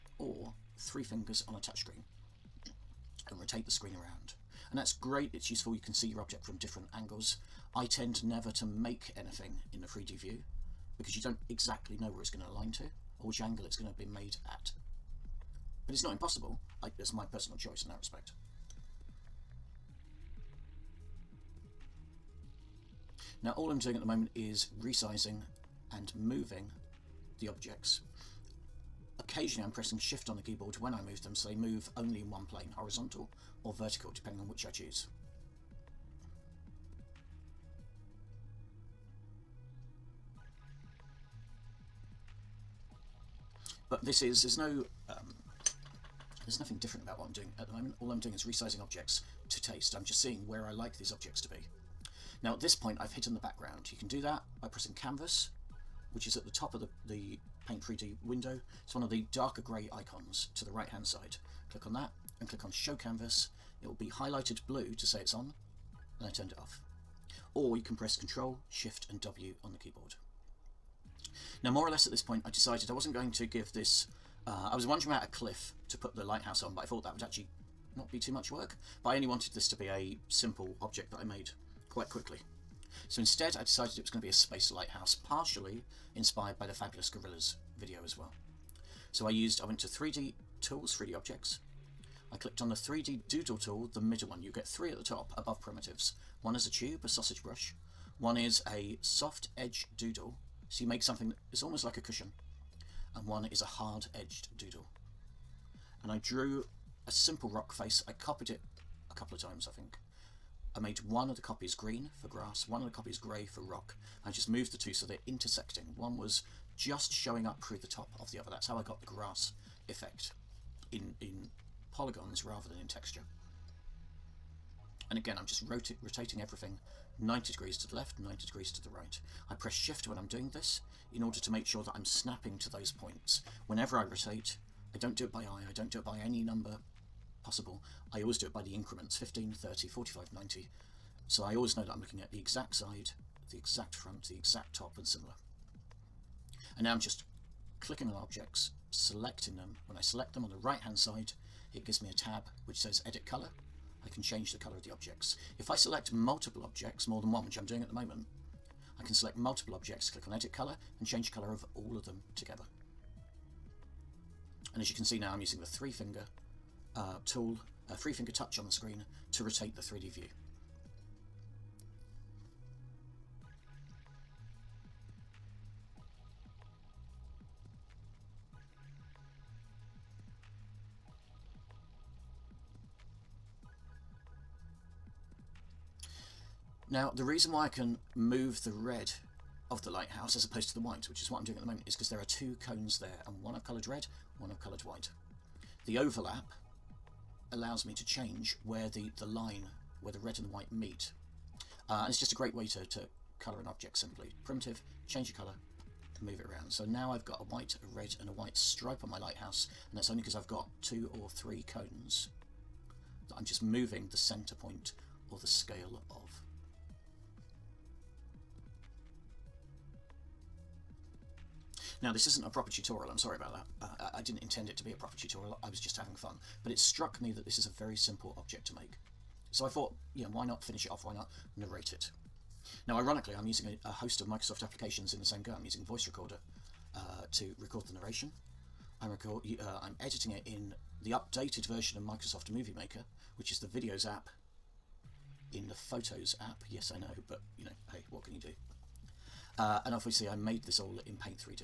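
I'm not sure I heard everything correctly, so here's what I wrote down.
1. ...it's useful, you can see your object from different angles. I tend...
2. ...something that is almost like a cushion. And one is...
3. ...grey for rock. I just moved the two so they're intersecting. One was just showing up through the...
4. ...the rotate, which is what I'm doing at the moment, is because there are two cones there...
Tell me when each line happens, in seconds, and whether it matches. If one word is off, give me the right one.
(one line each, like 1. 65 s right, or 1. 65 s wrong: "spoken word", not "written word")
1. 5 s right
2. 101 s right
3. 113 s right
4. 190 s wrong: "white", not "rotate".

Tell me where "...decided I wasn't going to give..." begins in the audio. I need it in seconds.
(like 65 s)
72 s.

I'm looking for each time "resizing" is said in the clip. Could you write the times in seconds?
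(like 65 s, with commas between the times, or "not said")
24 s, 48 s.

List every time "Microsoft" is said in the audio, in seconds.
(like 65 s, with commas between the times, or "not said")
234 s, 242 s.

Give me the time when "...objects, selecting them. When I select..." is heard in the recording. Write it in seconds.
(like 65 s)
148 s.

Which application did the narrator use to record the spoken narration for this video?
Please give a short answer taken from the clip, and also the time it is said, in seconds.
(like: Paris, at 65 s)
Voice Recorder, at 235 s.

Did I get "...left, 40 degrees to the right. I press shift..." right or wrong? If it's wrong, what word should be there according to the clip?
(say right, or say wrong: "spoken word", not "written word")
wrong: "90", not "40".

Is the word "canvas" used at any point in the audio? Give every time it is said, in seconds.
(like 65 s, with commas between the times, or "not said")
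54 s, 62 s.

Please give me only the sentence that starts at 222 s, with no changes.
Now this isn't a proper tutorial, I'm sorry about that.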